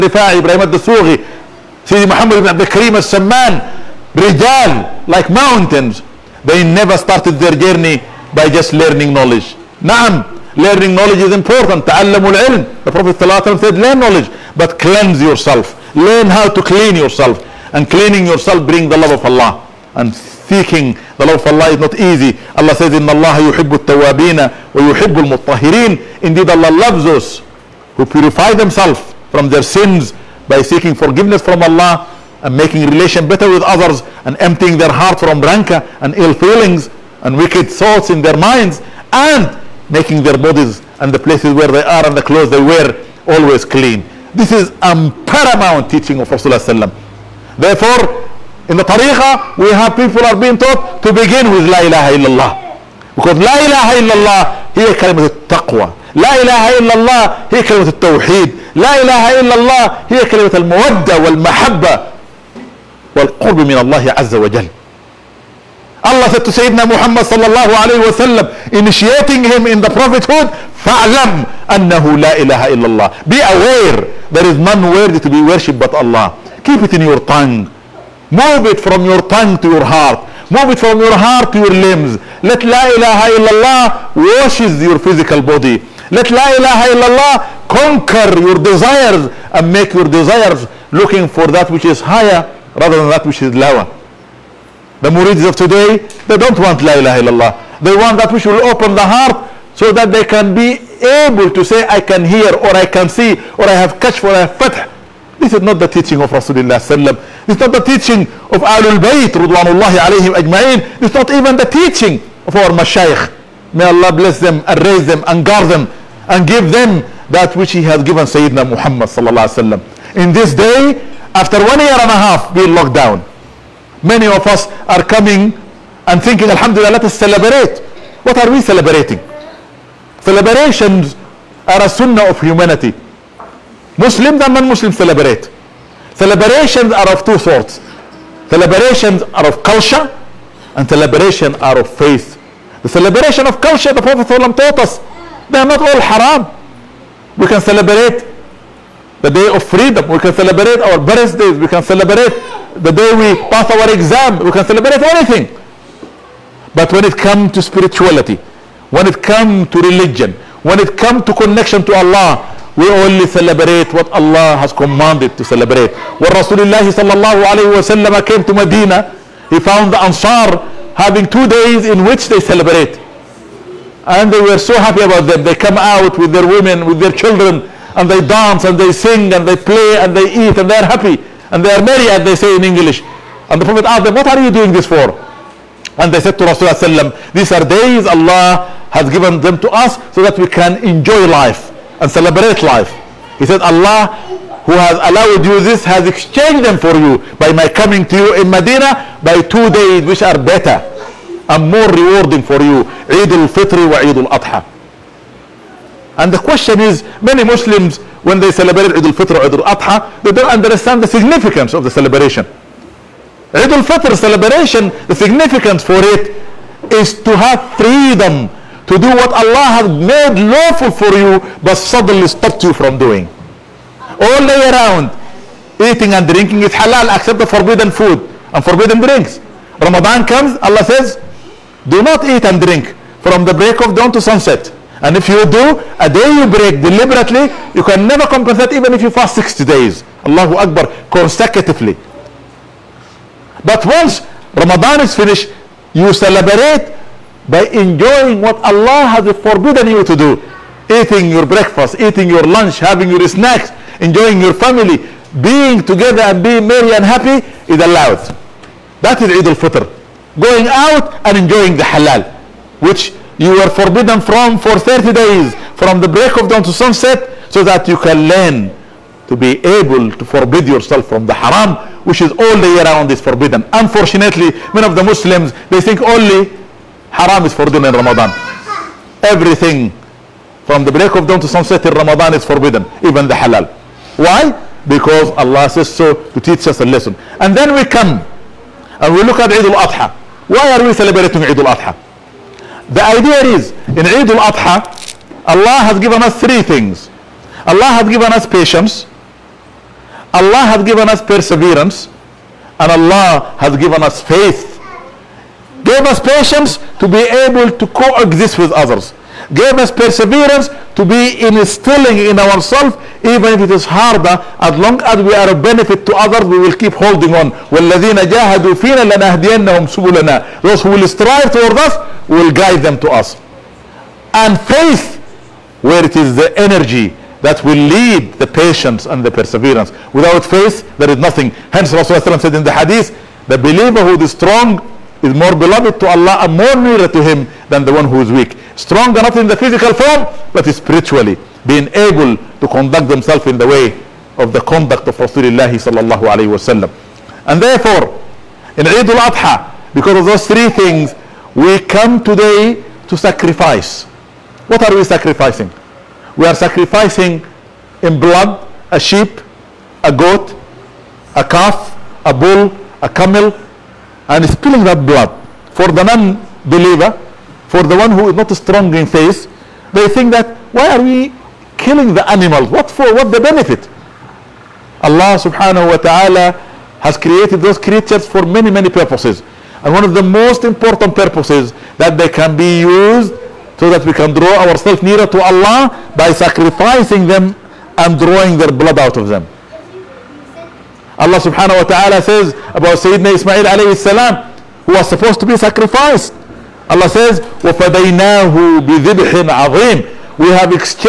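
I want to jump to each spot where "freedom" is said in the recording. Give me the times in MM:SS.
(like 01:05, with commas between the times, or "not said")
02:29, 03:37.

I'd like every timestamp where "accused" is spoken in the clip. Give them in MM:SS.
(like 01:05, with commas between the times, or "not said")
not said.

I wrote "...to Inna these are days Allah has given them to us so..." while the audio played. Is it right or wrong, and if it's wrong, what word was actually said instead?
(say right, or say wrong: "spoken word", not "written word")
wrong: "Rasulullah", not "Inna".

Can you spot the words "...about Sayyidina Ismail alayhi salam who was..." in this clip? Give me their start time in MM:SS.
06:32.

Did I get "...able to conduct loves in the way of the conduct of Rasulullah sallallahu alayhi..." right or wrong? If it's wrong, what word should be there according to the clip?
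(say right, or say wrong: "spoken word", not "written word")
wrong: "themselves", not "loves".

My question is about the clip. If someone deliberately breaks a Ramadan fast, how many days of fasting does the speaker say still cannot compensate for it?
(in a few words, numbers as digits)
60.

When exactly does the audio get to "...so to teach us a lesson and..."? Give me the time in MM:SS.
04:45.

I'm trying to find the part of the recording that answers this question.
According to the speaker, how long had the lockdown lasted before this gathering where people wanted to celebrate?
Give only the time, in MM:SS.
02:01.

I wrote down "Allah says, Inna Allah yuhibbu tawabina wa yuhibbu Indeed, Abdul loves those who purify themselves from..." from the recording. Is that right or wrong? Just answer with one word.
wrong.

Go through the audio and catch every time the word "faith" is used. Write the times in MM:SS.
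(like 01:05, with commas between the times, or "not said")
02:21, 05:04, 05:24, 05:30, 06:09.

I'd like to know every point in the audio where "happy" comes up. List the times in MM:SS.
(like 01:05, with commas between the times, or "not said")
02:54, 03:00, 04:17.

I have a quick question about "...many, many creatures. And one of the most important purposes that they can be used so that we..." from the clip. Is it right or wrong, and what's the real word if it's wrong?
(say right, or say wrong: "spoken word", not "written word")
wrong: "purposes", not "creatures".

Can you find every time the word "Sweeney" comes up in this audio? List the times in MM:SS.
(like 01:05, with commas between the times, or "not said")
not said.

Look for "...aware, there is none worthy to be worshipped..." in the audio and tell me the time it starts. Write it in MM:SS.
01:13.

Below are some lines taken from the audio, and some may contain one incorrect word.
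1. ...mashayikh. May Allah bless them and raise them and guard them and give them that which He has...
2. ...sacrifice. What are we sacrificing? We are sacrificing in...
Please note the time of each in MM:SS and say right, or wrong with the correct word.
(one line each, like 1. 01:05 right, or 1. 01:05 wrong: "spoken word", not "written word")
1. 01:52 right
2. 05:53 right.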